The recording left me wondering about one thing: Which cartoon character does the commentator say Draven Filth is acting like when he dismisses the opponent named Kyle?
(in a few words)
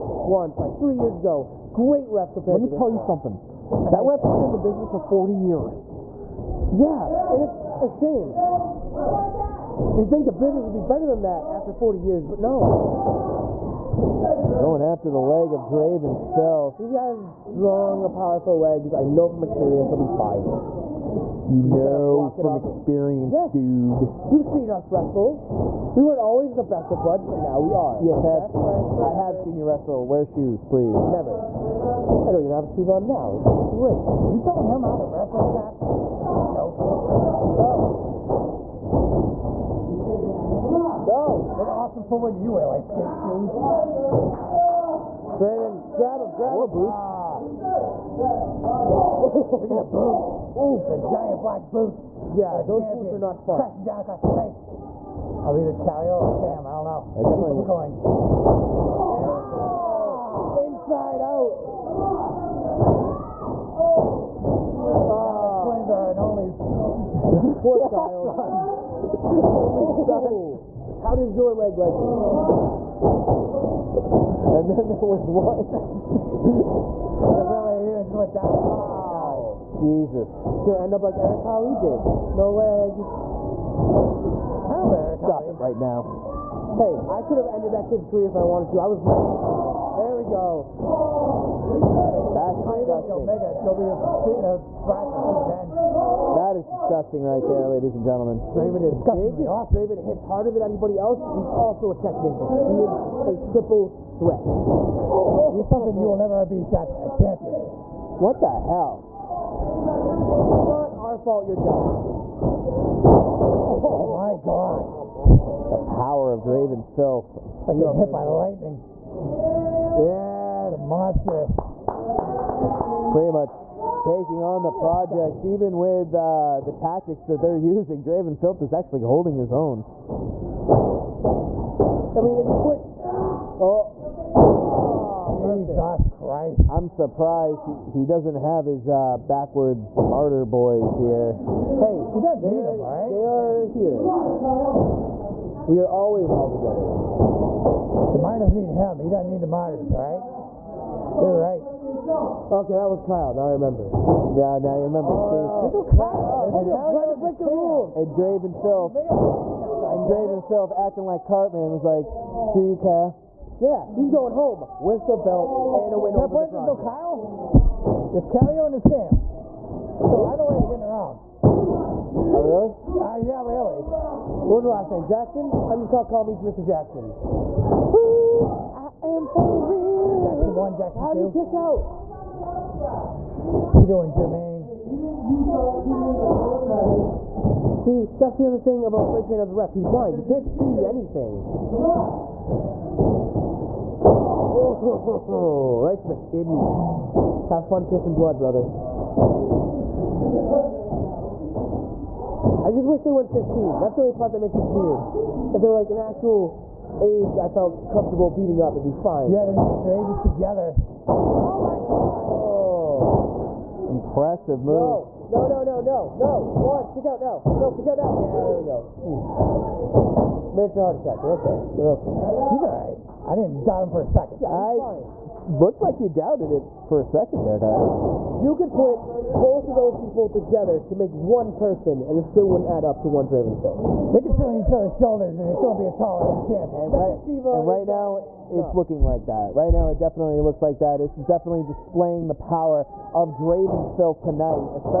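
Cartman.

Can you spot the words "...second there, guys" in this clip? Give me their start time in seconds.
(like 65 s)
227 s.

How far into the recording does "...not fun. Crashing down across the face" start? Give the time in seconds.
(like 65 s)
53 s.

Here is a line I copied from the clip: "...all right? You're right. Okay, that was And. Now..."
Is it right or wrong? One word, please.
wrong.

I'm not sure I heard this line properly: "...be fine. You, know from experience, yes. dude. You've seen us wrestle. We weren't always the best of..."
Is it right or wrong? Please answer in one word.
right.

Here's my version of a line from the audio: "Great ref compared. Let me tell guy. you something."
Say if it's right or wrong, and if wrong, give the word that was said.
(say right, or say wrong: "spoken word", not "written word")
right.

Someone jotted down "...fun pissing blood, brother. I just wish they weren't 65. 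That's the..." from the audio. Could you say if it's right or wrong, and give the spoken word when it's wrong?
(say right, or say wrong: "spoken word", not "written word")
wrong: "15", not "65".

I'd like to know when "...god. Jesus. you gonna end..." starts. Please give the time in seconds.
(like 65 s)
79 s.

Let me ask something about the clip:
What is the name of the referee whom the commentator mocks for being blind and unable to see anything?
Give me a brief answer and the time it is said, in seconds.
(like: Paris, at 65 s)
Fred Train, at 189 s.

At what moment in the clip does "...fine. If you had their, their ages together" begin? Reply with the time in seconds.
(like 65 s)
208 s.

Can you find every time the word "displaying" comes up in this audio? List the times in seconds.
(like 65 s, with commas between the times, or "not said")
241 s.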